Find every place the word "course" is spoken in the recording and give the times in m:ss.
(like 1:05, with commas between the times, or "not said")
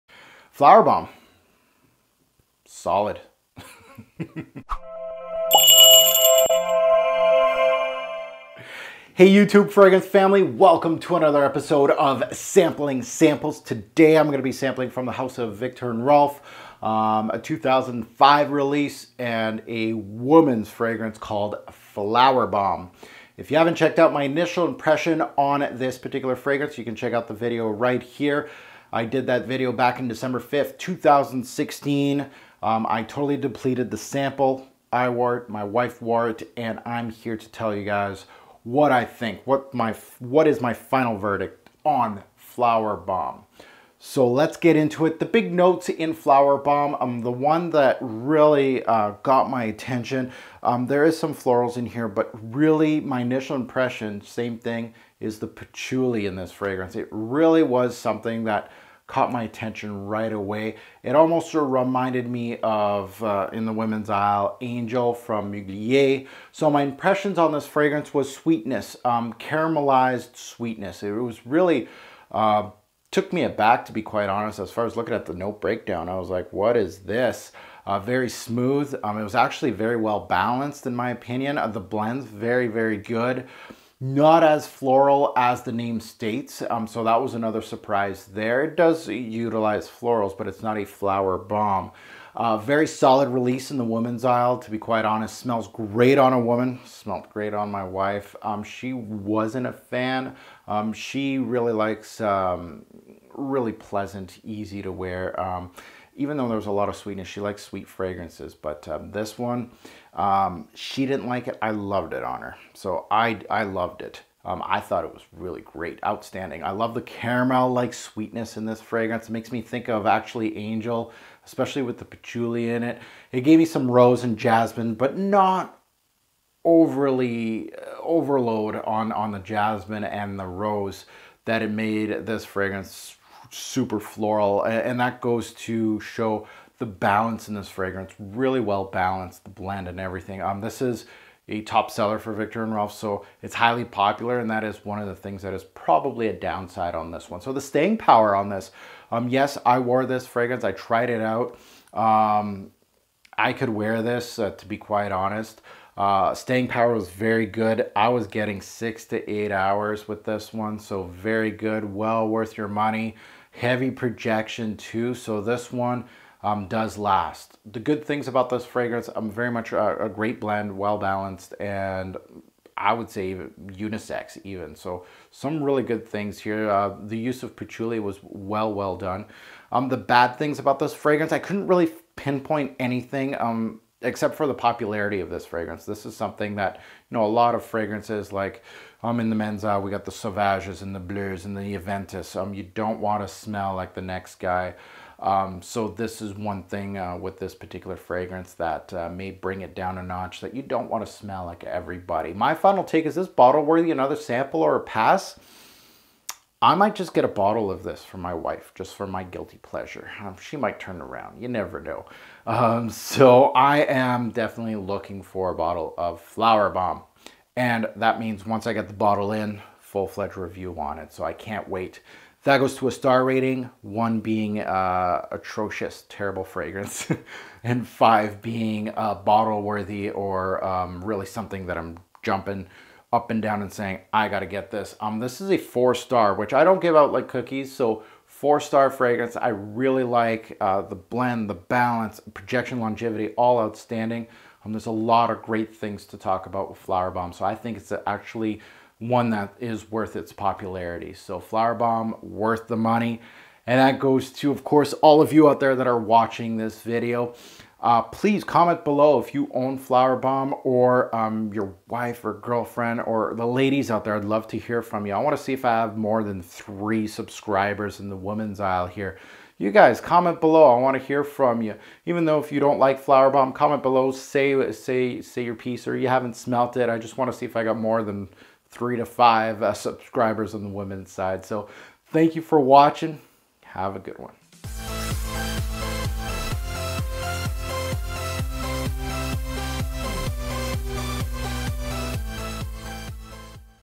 4:14.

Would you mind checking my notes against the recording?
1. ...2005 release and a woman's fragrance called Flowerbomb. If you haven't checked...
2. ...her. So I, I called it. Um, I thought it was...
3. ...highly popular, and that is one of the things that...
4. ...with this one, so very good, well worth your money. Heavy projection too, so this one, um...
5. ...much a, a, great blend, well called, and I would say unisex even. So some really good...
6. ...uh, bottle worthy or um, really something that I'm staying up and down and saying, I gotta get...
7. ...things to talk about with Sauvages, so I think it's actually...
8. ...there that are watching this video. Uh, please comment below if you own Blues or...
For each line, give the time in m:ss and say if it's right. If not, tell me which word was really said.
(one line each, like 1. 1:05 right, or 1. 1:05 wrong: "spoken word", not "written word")
1. 0:17 right
2. 1:52 wrong: "loved", not "called"
3. 2:23 right
4. 2:40 right
5. 2:49 wrong: "balanced", not "called"
6. 3:48 wrong: "jumping", not "staying"
7. 4:05 wrong: "Flowerbomb", not "Sauvages"
8. 4:15 wrong: "Flowerbomb", not "Blues".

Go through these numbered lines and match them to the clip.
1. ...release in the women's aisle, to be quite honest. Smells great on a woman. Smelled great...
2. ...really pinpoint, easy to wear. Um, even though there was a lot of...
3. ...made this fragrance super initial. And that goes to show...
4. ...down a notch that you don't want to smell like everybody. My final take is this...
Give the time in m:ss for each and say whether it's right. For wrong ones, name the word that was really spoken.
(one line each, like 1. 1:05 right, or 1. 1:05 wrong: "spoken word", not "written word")
1. 1:33 right
2. 1:43 wrong: "pleasant", not "pinpoint"
3. 2:11 wrong: "floral", not "initial"
4. 3:19 right.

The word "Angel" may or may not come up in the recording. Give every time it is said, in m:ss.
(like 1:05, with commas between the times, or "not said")
1:04, 2:00.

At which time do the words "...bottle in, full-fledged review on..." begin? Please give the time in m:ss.
3:38.